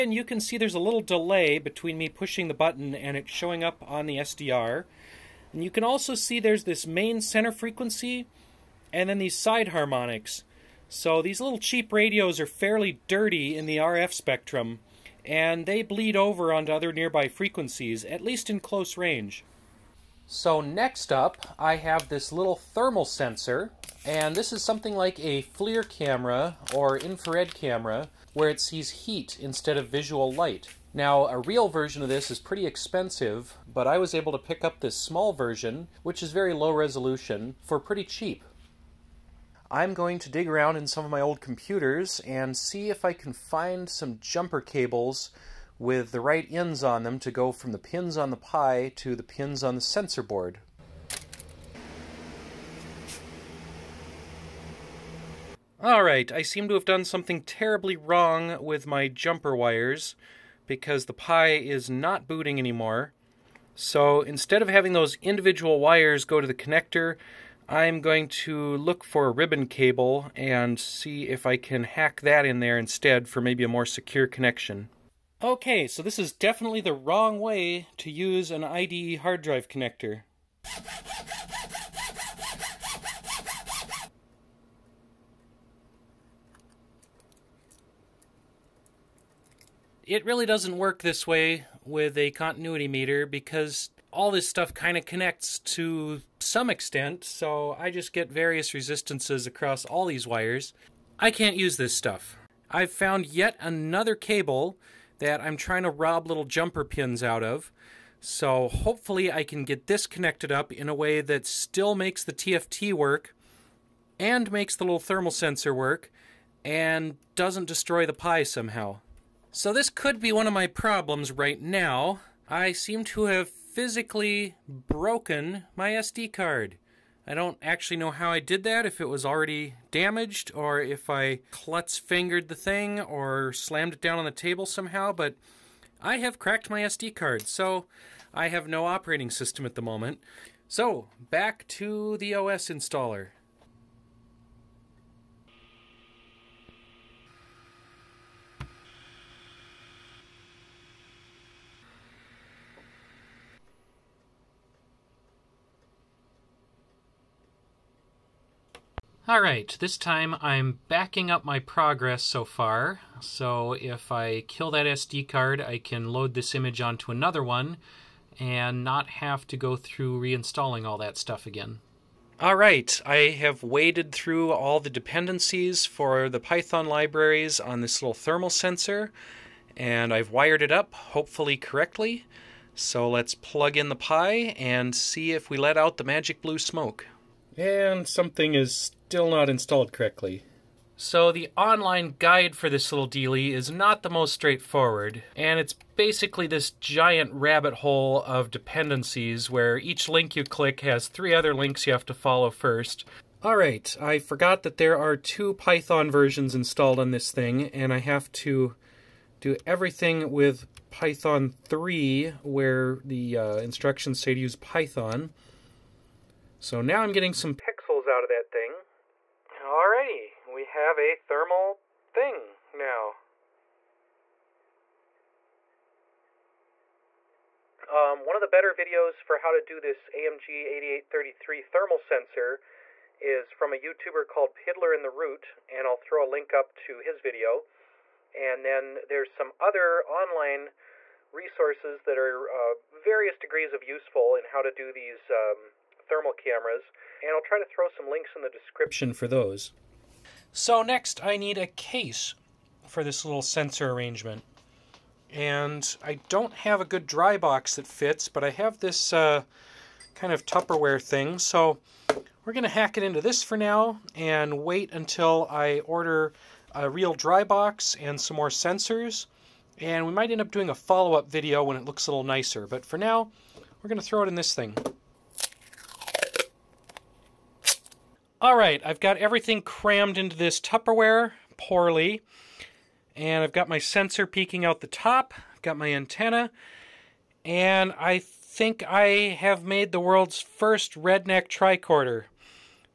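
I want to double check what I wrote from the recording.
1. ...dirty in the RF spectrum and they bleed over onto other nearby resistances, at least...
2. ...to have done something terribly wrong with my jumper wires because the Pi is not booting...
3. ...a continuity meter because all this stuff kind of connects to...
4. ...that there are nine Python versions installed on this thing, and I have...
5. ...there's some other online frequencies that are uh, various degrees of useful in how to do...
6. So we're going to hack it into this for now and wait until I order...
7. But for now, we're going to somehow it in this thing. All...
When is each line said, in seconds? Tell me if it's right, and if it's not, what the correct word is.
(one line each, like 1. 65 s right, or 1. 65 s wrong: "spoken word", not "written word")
1. 13 s wrong: "frequencies", not "resistances"
2. 56 s right
3. 92 s right
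4. 204 s wrong: "two", not "nine"
5. 239 s wrong: "resources", not "frequencies"
6. 261 s right
7. 272 s wrong: "throw", not "somehow".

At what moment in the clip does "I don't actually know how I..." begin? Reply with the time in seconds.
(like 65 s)
127 s.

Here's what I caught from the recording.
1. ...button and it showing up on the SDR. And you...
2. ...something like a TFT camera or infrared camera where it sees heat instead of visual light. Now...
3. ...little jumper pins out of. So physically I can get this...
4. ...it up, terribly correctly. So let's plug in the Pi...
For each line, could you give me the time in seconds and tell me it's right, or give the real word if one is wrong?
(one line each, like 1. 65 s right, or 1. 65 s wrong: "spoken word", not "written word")
1. 2 s right
2. 24 s wrong: "FLIR", not "TFT"
3. 106 s wrong: "hopefully", not "physically"
4. 180 s wrong: "hopefully", not "terribly".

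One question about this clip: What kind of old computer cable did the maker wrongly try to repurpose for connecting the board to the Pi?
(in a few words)
IDE hard drive connector.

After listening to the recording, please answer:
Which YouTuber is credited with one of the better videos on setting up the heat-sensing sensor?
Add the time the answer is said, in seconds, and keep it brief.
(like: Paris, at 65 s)
Piddler in the Root, at 234 s.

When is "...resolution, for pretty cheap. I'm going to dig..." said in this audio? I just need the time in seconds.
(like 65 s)
36 s.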